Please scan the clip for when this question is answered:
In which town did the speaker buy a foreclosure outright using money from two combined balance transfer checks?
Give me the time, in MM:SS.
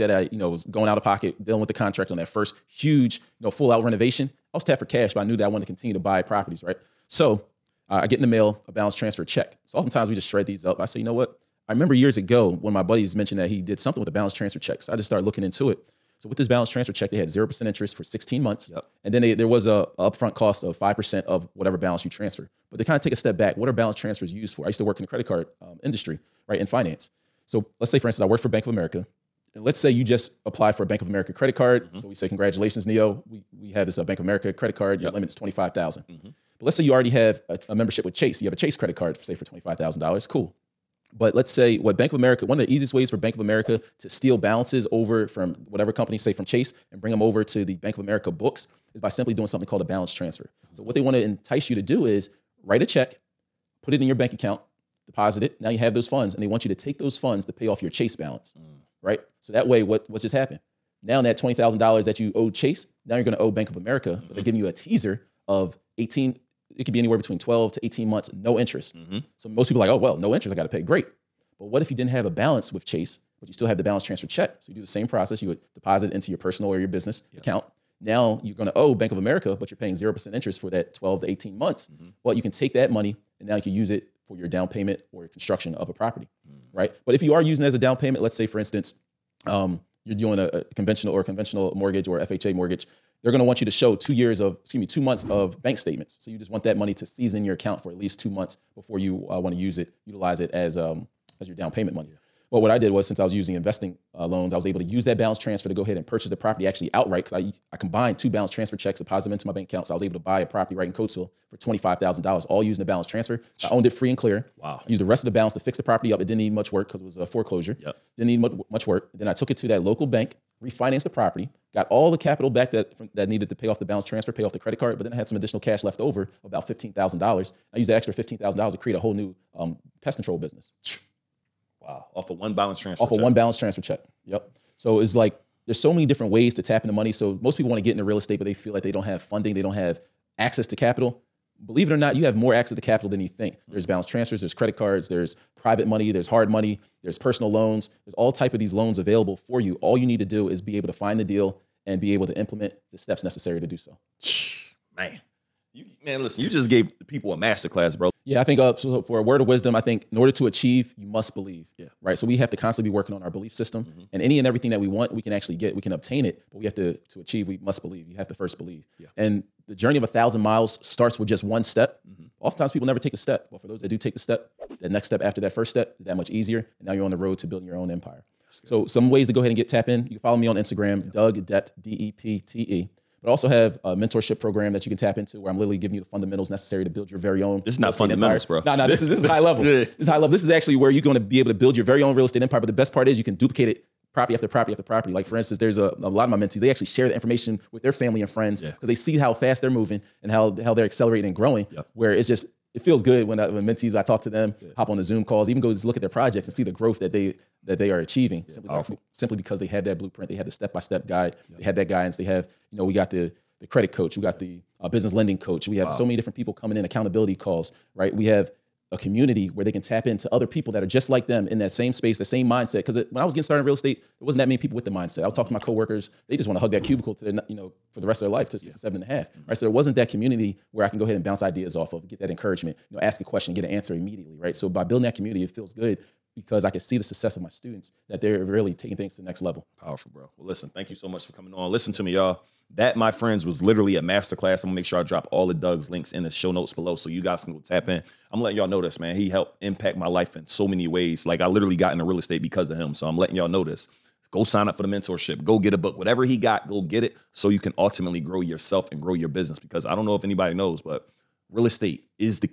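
01:50.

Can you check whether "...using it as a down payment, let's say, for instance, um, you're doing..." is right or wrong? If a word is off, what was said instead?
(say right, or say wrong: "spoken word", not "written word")
right.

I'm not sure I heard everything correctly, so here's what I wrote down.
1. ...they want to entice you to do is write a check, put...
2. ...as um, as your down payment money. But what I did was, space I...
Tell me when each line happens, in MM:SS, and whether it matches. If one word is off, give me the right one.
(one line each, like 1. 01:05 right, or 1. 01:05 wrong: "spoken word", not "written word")
1. 00:50 right
2. 01:40 wrong: "since", not "space".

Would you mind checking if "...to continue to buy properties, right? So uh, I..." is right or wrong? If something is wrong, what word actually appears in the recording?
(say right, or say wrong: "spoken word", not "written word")
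right.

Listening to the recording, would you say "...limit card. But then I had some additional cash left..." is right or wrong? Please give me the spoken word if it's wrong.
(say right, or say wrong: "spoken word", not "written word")
wrong: "credit", not "limit".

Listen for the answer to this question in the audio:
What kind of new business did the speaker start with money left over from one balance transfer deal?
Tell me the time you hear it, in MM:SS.
02:10.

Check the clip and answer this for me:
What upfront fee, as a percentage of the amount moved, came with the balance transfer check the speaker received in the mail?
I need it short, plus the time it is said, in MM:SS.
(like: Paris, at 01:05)
5%, at 00:20.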